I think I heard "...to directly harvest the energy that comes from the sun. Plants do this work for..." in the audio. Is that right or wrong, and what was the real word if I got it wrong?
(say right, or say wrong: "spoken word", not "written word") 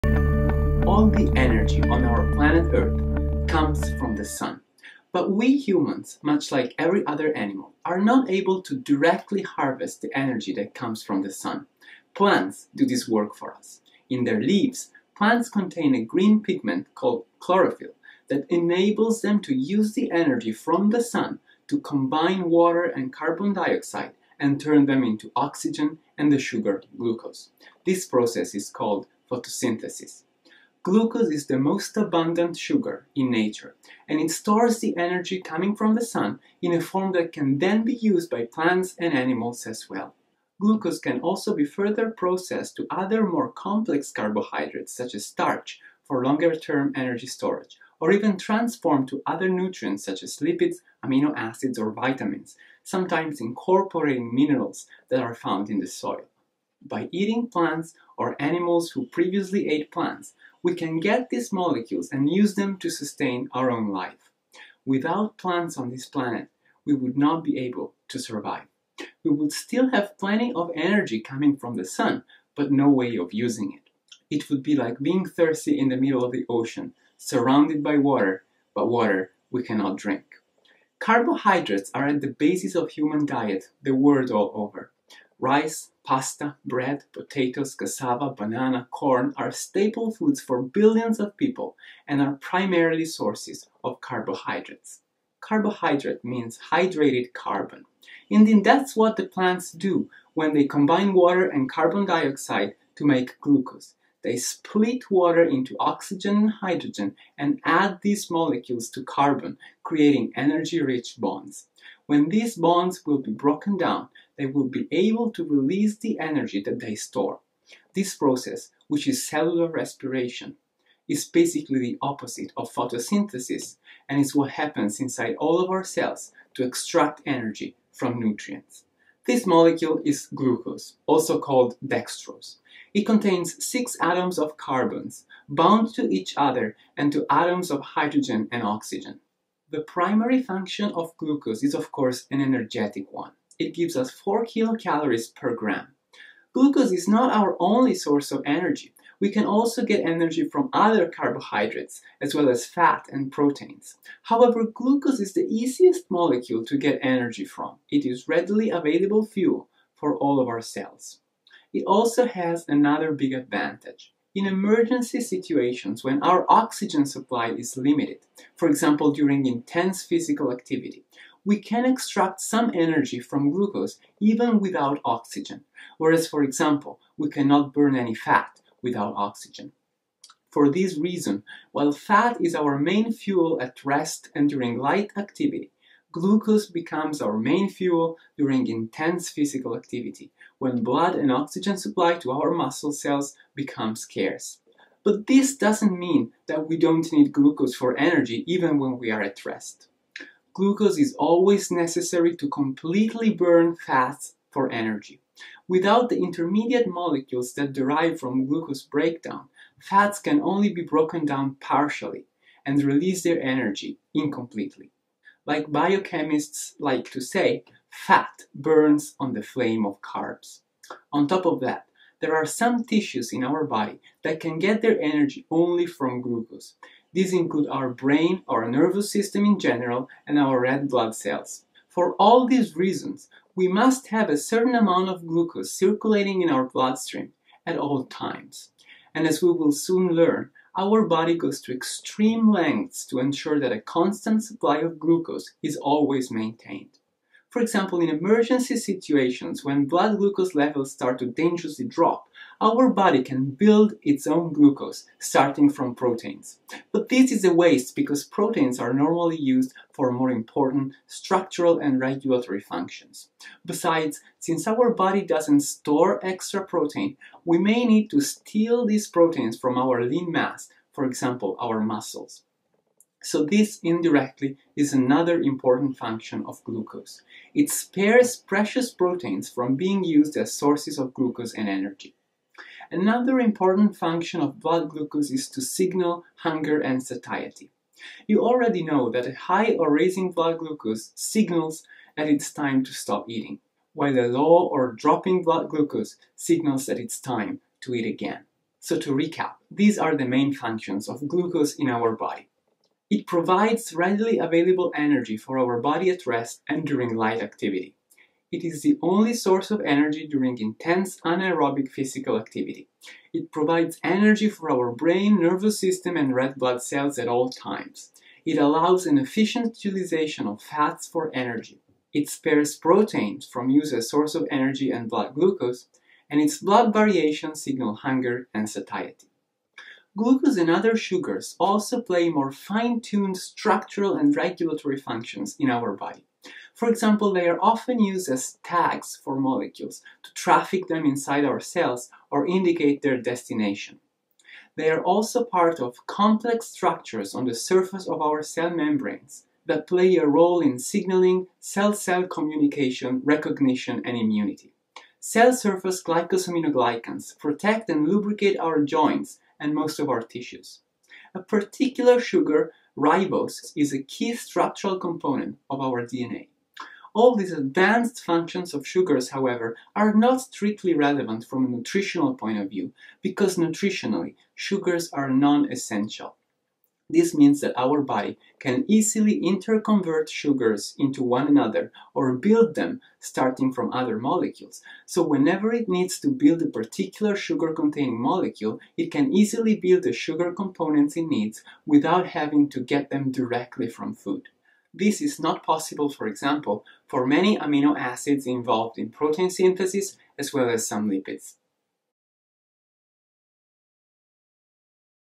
right.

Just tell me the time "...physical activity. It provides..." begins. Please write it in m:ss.
5:11.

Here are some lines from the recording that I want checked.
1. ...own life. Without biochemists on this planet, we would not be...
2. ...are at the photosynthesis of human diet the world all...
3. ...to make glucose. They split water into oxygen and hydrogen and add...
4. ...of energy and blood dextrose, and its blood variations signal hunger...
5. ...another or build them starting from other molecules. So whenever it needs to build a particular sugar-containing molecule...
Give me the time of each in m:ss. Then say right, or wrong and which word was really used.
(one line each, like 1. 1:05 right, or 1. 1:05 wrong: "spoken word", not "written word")
1. 1:03 wrong: "plants", not "biochemists"
2. 1:21 wrong: "basis", not "photosynthesis"
3. 1:42 right
4. 5:24 wrong: "glucose", not "dextrose"
5. 6:21 right.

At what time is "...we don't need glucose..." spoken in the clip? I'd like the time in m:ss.
3:16.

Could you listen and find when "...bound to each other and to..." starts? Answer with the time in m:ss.
2:15.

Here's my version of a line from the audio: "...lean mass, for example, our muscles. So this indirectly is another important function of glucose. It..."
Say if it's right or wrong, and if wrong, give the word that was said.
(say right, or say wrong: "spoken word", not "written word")
right.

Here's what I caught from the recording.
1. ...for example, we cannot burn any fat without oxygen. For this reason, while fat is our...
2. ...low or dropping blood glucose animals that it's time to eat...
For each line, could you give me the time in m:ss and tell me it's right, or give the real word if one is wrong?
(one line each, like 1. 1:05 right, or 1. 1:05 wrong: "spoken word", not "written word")
1. 2:56 right
2. 4:54 wrong: "signals", not "animals".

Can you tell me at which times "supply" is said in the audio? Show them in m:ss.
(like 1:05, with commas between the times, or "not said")
2:47, 3:11, 4:04.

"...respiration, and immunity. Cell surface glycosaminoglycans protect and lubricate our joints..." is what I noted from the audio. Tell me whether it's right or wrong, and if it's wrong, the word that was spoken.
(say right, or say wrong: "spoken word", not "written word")
wrong: "recognition", not "respiration".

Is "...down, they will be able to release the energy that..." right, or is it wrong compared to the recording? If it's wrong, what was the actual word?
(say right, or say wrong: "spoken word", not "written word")
right.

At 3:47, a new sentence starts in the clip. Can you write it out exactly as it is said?
These include our brain, our nervous system in general, and our red blood cells.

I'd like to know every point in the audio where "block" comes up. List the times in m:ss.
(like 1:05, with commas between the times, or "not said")
not said.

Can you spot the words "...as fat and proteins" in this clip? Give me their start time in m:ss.
2:32.